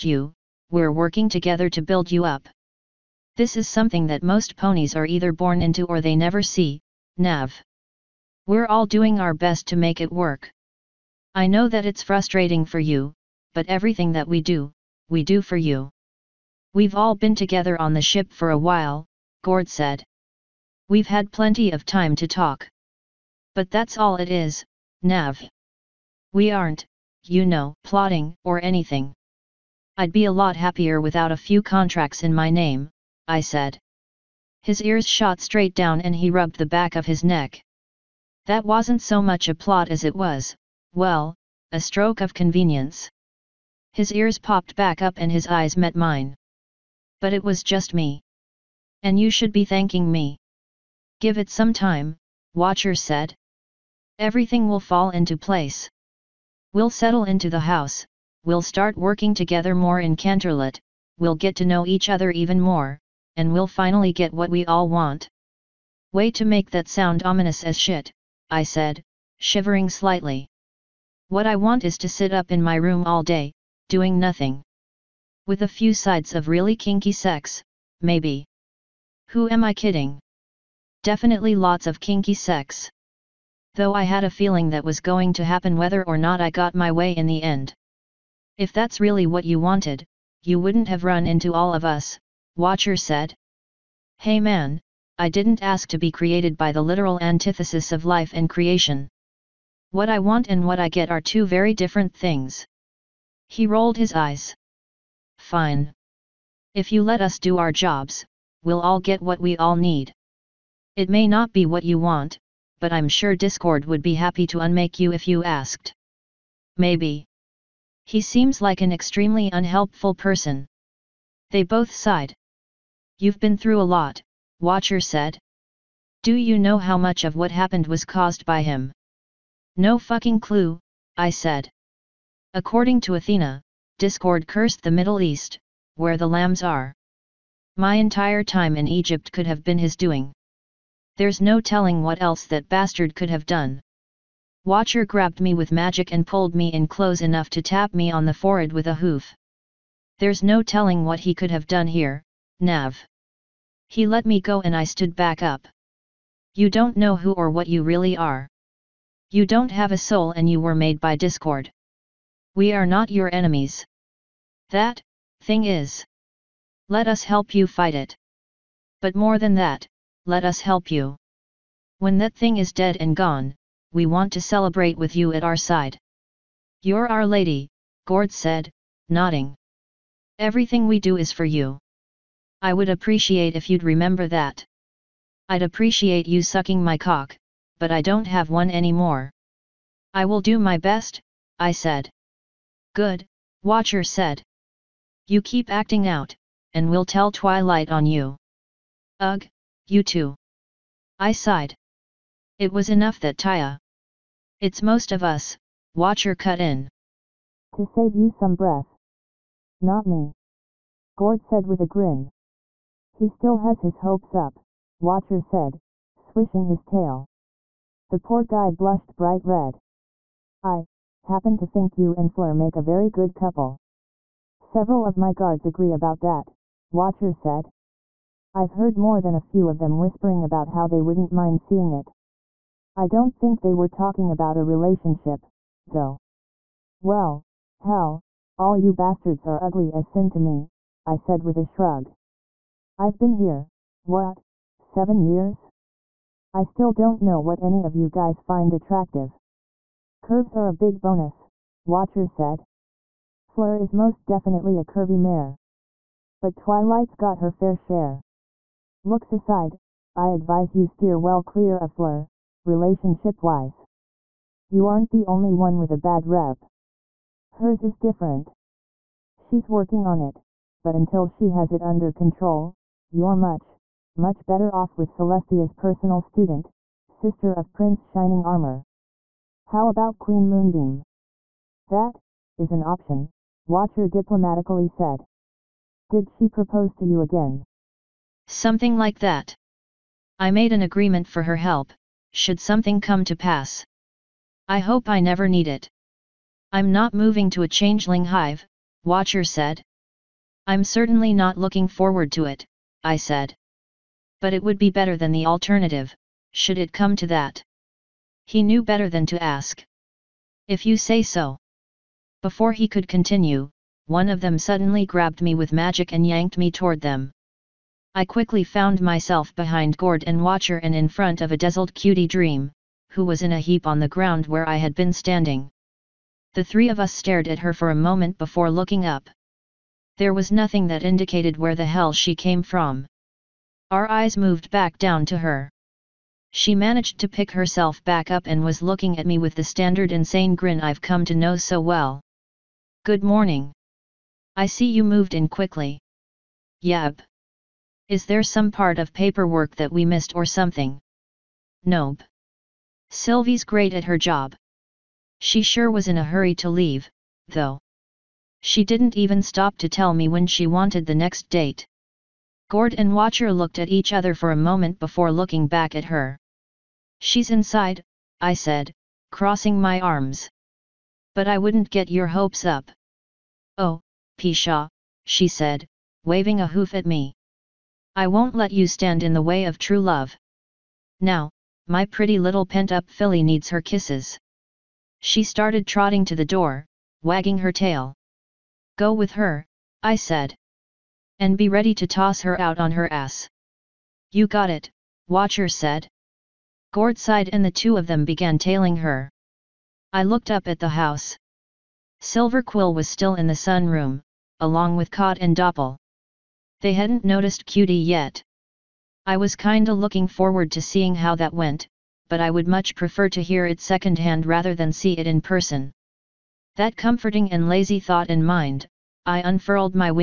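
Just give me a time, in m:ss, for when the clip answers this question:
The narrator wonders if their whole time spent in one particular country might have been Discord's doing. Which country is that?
2:18.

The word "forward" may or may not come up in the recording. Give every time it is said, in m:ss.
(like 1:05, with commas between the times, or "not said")
5:01, 6:50.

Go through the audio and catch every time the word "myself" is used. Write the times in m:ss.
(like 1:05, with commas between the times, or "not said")
5:19.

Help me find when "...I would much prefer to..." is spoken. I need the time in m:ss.
6:52.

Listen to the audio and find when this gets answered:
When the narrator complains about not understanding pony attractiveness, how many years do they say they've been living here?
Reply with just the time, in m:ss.
4:04.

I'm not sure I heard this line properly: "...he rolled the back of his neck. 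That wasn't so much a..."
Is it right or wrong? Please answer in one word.
wrong.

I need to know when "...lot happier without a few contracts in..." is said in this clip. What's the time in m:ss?
0:30.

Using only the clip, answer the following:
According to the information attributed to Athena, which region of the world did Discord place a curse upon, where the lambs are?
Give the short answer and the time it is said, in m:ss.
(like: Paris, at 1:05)
Middle East, at 2:14.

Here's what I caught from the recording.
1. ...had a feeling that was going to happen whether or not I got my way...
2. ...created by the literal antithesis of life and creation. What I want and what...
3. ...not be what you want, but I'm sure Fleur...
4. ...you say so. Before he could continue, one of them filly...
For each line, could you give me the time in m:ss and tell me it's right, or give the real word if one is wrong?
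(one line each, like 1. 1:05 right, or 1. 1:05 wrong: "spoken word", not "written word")
1. 1:24 right
2. 1:36 right
3. 1:51 wrong: "Discord", not "Fleur"
4. 5:10 wrong: "suddenly", not "filly".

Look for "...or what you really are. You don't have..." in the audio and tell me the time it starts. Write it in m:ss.
2:37.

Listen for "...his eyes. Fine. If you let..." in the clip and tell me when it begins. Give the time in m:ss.
1:43.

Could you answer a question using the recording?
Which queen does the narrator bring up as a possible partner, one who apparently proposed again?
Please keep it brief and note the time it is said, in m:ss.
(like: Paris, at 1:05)
Queen Moonbeam, at 4:40.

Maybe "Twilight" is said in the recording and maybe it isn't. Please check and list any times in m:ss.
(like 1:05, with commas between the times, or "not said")
3:17, 4:16.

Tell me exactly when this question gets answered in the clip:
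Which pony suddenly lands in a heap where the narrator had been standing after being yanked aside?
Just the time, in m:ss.
5:21.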